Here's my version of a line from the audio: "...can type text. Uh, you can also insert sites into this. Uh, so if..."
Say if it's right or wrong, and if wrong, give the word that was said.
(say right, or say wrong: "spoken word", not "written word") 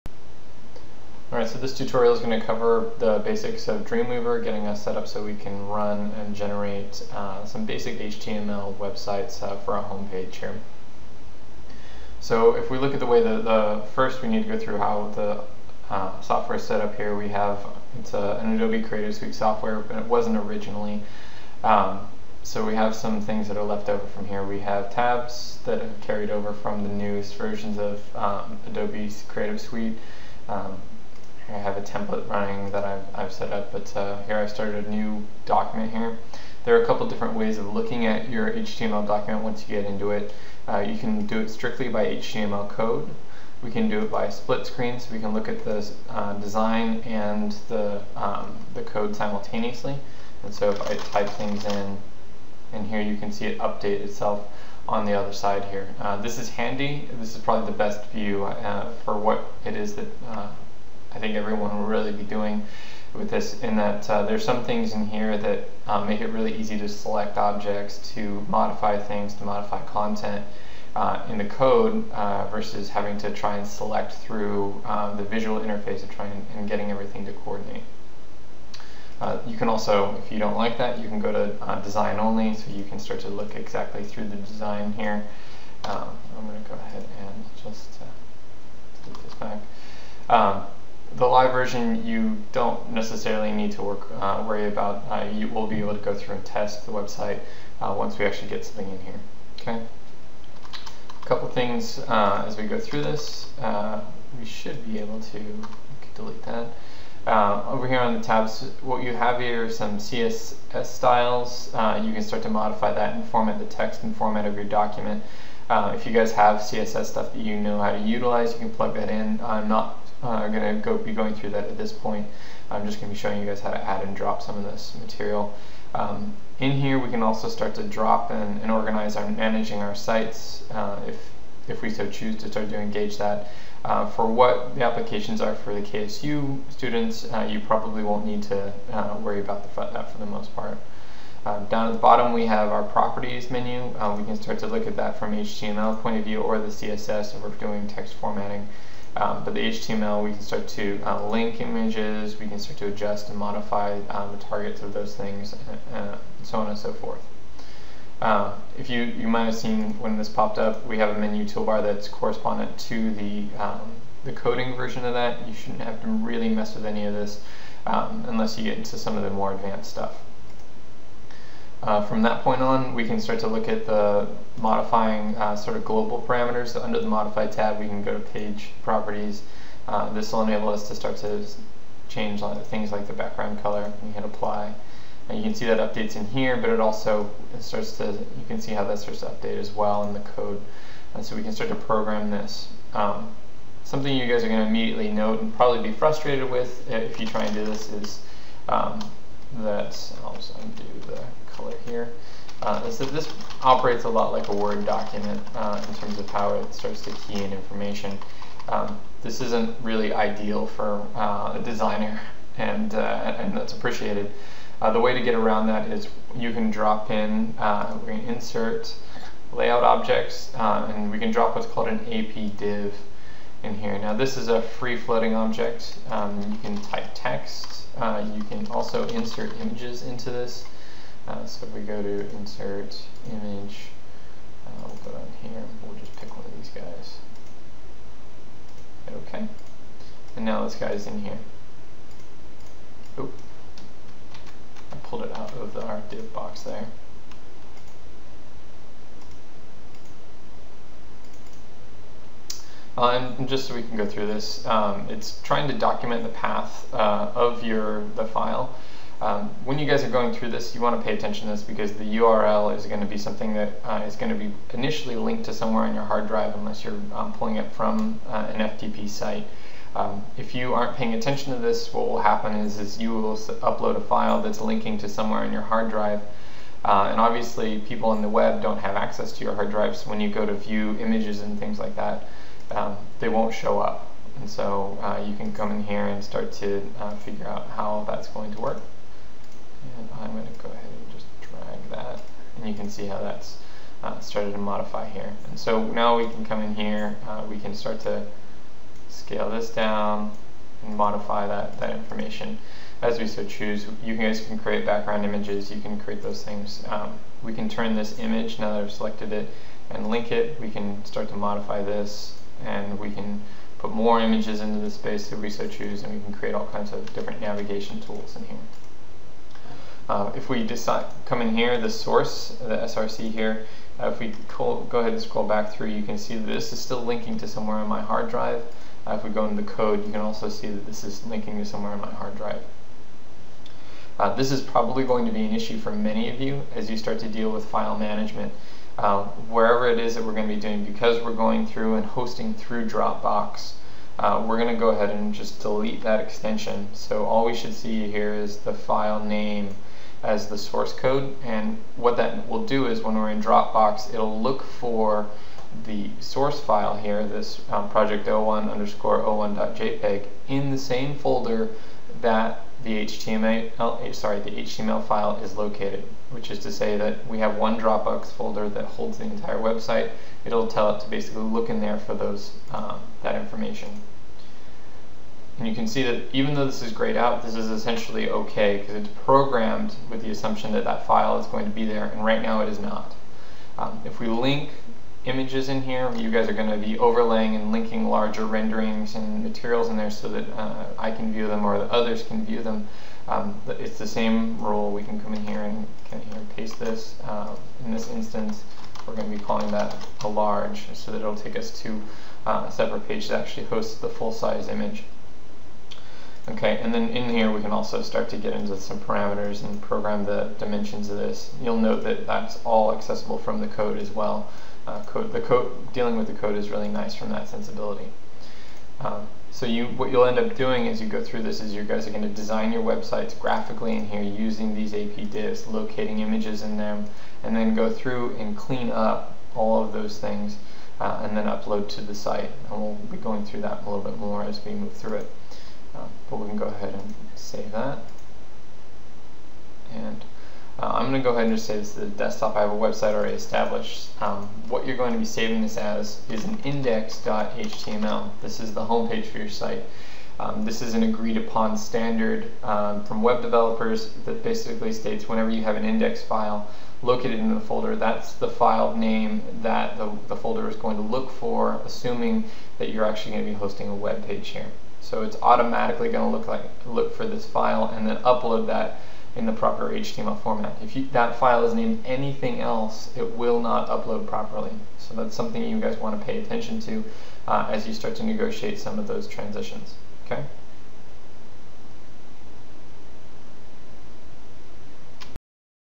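wrong: "images", not "sites".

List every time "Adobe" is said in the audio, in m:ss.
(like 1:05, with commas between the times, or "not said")
0:18, 0:28.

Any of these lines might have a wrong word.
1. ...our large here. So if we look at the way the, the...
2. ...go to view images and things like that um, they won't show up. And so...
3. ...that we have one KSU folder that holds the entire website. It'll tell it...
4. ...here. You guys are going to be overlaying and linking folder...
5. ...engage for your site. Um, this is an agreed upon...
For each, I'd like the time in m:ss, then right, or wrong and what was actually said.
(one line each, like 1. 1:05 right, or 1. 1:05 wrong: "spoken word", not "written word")
1. 0:09 wrong: "homepage", not "large"
2. 4:40 right
3. 6:06 wrong: "Dropbox", not "KSU"
4. 6:25 wrong: "larger", not "folder"
5. 7:28 wrong: "homepage", not "engage".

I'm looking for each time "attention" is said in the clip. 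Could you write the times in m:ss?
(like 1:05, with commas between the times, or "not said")
4:21, 4:31, 7:56.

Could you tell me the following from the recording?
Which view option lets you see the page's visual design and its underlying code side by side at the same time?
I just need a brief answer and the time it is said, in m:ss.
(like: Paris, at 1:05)
Split screen, at 0:44.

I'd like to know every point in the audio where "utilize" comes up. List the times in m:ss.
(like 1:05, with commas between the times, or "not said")
1:57.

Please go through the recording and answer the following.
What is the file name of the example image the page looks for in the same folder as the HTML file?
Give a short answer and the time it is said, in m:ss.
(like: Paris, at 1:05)
project01_01.jpg, at 5:57.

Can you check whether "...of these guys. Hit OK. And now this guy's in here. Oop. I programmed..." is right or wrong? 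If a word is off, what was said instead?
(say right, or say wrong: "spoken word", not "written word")
wrong: "pulled", not "programmed".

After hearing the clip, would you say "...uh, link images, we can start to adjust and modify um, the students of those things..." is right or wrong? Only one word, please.
wrong.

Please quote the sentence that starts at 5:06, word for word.
Um, we can turn this image, now that I've selected it, and link it.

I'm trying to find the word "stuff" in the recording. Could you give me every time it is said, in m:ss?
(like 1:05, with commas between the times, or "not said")
1:57, 2:49.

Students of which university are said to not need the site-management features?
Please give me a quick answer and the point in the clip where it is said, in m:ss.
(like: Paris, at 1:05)
KSU, at 2:15.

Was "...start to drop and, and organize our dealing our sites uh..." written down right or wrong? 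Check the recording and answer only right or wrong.
wrong.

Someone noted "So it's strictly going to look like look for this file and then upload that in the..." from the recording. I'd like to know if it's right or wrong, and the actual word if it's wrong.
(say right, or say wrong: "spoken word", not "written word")
wrong: "automatically", not "strictly".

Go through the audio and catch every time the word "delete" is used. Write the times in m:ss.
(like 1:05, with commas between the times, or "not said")
1:46, 5:45.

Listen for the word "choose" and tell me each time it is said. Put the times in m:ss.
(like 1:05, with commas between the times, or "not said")
2:12, 5:03, 5:15.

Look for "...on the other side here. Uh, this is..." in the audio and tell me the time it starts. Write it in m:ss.
0:54.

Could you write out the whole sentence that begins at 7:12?
And we'll be going through that a little bit more as we move through it.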